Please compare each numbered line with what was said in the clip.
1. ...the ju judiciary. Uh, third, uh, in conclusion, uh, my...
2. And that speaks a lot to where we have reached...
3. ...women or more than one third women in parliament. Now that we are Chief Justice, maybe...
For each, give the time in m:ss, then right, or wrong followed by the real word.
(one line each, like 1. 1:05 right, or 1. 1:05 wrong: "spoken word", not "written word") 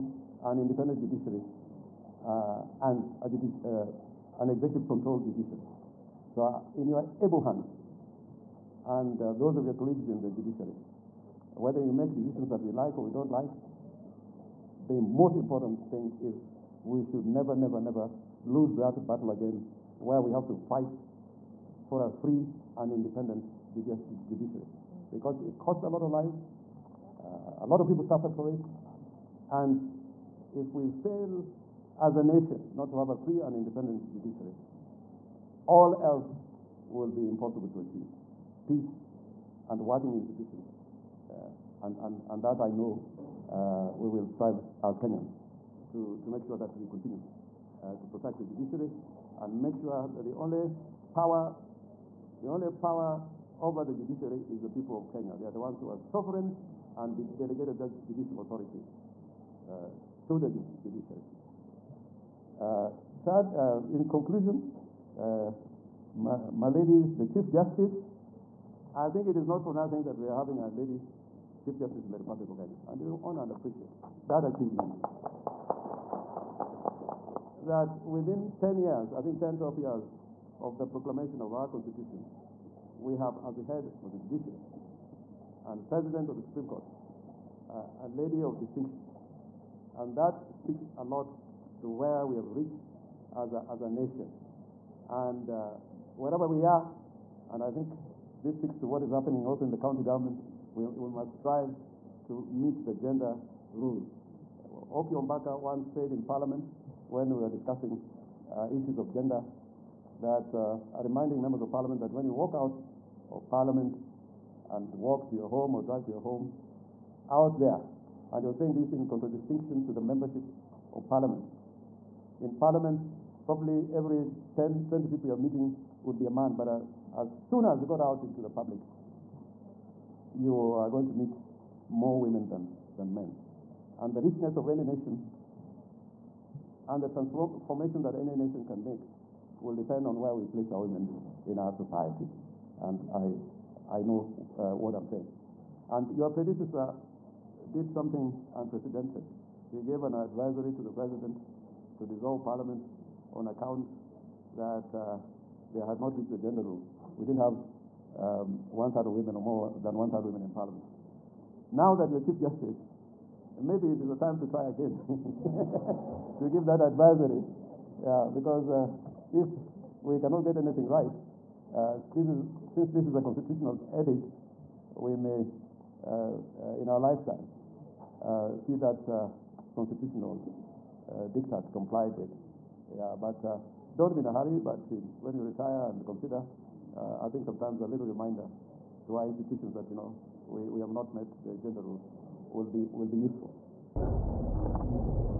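1. 1:00 right
2. 1:29 right
3. 2:39 right.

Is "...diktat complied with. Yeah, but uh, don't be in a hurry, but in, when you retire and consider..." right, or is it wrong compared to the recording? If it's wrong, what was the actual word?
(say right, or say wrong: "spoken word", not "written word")
right.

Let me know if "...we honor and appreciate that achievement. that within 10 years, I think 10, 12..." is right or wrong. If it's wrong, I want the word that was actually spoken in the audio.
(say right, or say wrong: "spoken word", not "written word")
right.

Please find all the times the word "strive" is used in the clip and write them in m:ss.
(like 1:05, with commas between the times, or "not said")
0:44, 1:41.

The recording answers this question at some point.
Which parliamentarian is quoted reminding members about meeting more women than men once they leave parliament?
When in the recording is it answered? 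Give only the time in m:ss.
1:44.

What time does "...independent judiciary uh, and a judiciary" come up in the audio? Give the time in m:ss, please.
0:00.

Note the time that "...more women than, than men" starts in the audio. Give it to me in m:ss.
2:11.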